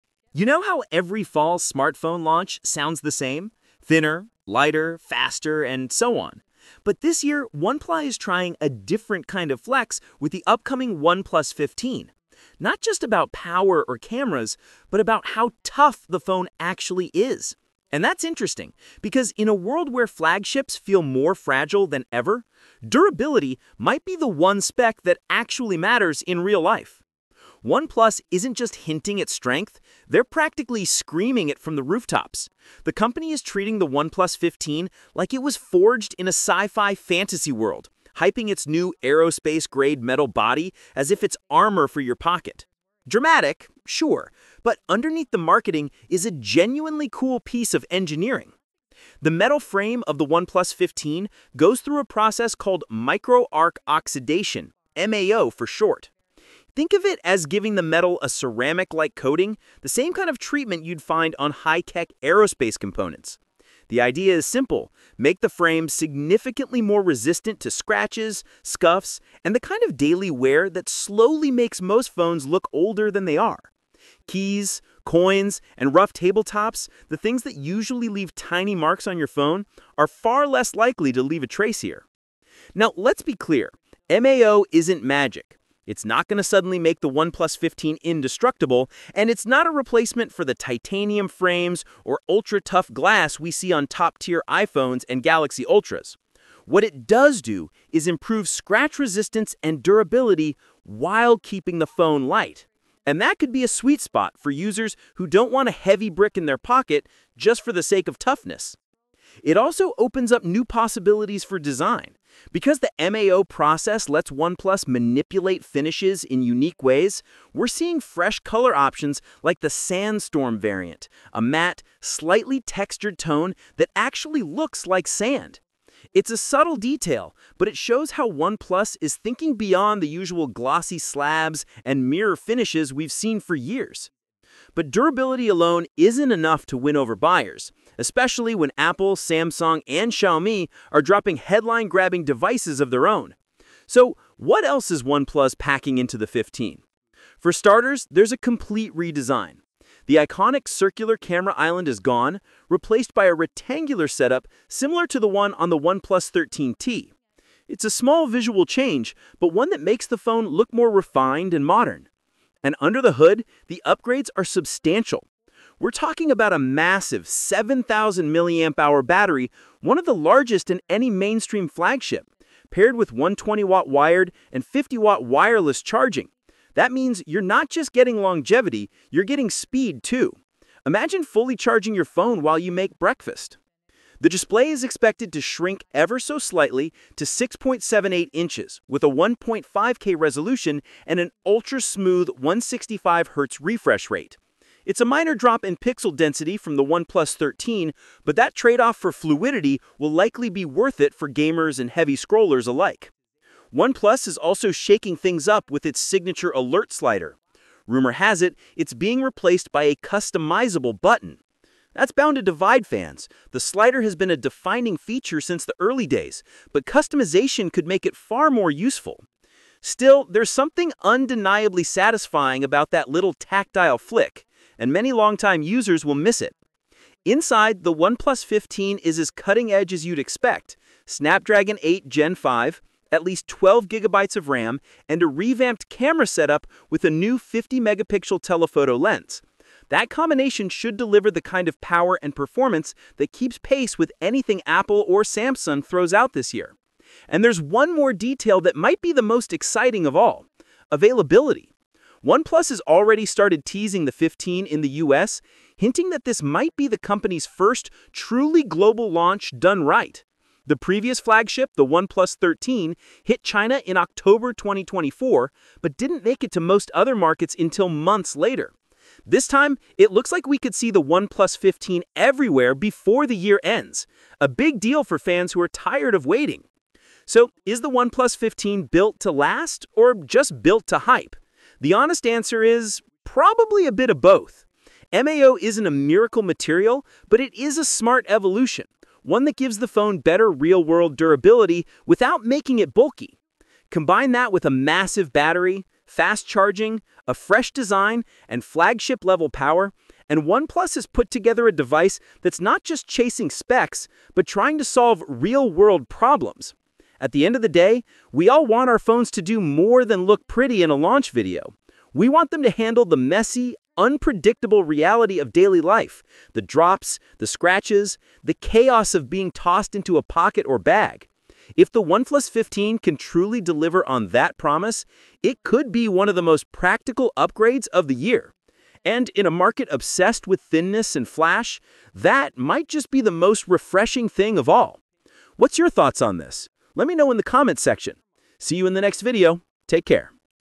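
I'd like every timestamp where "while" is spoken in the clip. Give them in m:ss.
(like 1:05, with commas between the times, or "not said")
1:40, 3:02.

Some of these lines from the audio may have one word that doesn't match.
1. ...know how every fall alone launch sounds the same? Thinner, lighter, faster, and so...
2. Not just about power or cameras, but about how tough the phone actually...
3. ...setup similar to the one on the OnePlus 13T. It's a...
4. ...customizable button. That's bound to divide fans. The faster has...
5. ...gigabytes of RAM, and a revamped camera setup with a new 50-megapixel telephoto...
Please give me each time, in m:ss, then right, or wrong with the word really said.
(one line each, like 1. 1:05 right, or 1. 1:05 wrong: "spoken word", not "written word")
1. 0:00 wrong: "smartphone", not "alone"
2. 0:12 right
3. 2:34 right
4. 3:29 wrong: "slider", not "faster"
5. 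3:53 right.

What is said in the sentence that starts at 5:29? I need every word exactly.
And in a market obsessed with thinness and flash, that might just be the most refreshing thing of all.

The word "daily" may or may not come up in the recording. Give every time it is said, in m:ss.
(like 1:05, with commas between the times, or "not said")
1:09, 5:15.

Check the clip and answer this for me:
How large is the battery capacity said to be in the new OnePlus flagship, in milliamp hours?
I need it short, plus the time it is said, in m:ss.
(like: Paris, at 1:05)
7,000, at 2:47.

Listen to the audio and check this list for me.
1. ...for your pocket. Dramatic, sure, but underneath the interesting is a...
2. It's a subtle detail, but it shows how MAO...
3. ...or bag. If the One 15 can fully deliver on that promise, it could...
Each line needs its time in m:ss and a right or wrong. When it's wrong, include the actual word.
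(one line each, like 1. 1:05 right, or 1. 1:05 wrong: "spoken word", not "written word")
1. 0:41 wrong: "marketing", not "interesting"
2. 2:06 wrong: "OnePlus", not "MAO"
3. 5:20 wrong: "truly", not "fully".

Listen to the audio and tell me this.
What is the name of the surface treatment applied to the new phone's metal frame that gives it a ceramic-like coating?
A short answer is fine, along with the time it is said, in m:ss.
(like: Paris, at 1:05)
micro arc oxidation, at 0:52.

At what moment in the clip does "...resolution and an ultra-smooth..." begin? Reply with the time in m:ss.
3:10.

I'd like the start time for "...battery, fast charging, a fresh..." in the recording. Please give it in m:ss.
4:55.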